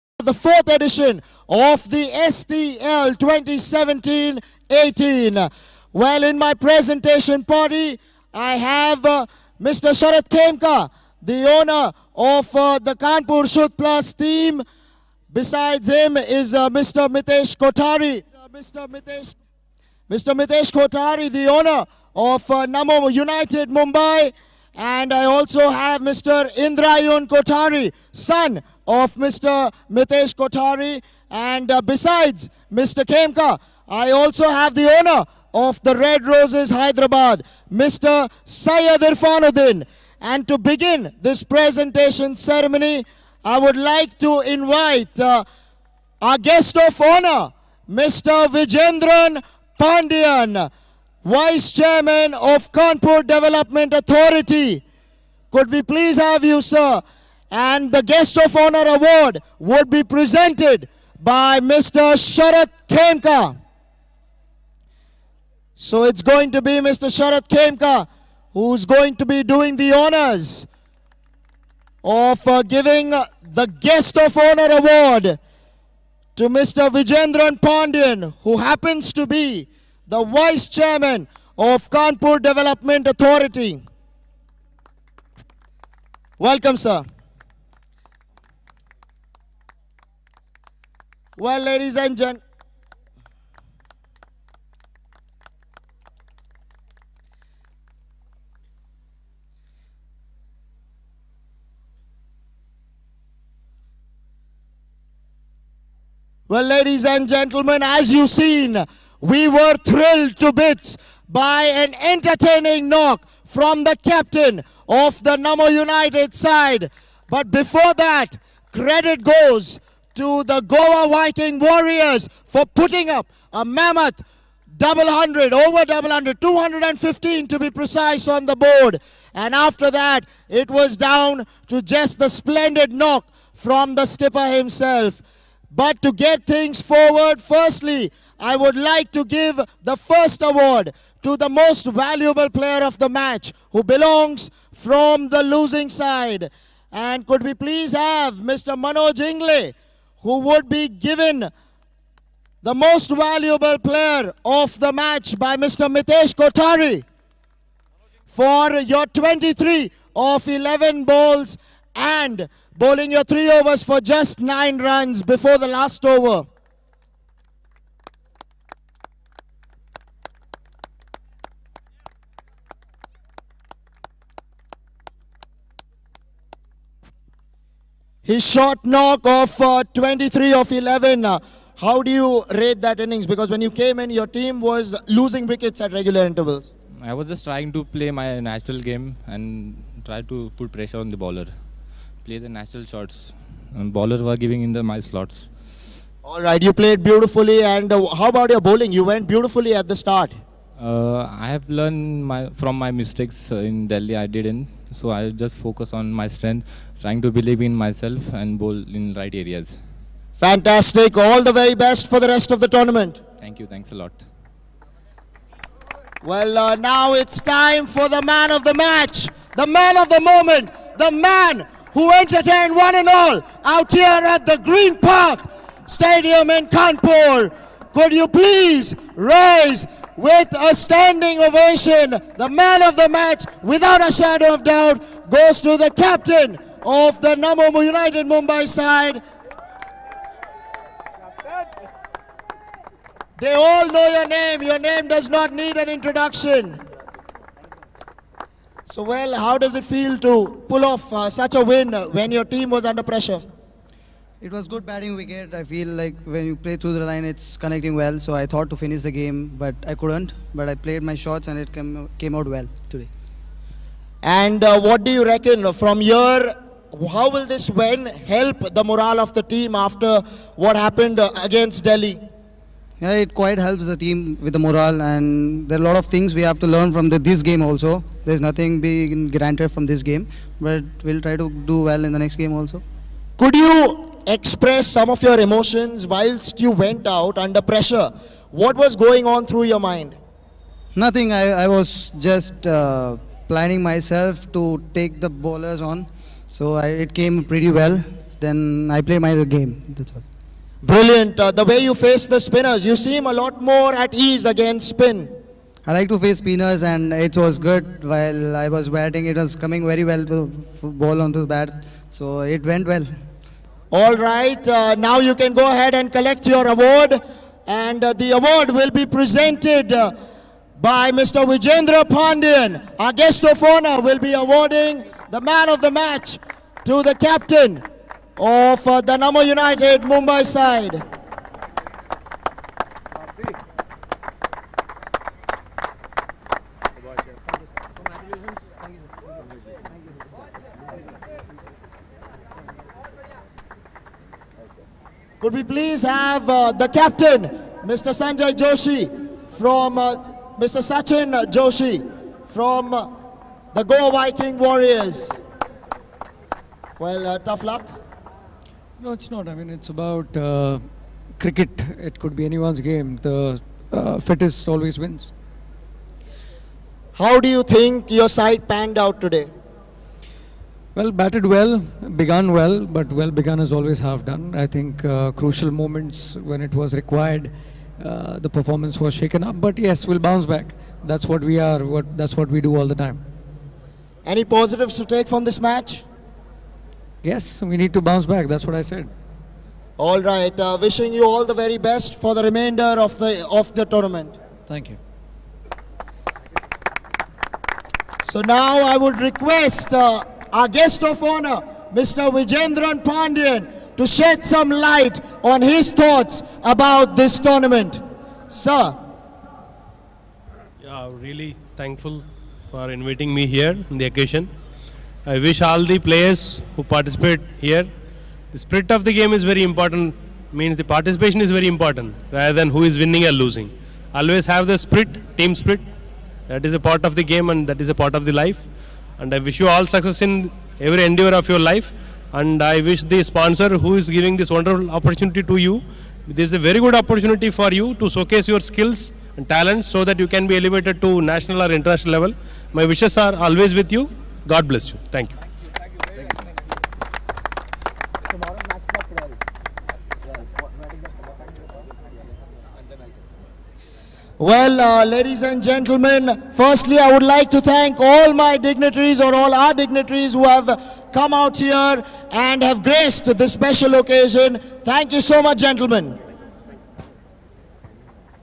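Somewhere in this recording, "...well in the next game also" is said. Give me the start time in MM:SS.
04:41.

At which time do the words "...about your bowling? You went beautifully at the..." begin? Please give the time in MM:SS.
03:18.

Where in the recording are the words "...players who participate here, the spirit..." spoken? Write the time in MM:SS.
06:55.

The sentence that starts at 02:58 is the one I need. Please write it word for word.
His short knock of uh, 23 of 11.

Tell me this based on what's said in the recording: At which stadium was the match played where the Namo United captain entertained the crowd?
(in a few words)
Green Park Stadium.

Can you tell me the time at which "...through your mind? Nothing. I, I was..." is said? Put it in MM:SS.
04:49.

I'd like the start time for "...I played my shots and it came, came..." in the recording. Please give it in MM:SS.
04:20.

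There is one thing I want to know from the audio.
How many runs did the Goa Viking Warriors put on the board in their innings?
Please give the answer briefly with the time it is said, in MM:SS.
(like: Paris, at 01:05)
215, at 02:06.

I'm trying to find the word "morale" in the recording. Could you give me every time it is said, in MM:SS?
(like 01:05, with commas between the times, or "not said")
04:28, 04:34.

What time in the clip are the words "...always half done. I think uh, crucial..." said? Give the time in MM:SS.
06:13.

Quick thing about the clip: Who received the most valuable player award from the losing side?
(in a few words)
Manoj Ingle.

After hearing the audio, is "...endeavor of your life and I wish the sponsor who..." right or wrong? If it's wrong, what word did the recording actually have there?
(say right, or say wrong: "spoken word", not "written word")
right.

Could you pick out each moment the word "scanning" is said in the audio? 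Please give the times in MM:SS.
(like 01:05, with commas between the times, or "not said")
not said.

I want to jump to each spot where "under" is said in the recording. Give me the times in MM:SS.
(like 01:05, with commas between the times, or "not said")
04:12, 04:47.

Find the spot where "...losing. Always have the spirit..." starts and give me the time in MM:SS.
07:03.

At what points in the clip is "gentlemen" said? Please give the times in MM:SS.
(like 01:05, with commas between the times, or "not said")
01:32, 01:47, 07:35, 07:45.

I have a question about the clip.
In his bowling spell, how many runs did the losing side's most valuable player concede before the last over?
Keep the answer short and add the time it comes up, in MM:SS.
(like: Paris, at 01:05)
9, at 02:44.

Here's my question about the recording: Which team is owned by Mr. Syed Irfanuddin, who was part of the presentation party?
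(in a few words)
Red Roses Hyderabad.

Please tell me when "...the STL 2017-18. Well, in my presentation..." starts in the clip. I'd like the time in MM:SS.
00:01.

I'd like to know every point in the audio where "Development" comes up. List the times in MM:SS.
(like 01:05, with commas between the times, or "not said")
00:53, 01:22.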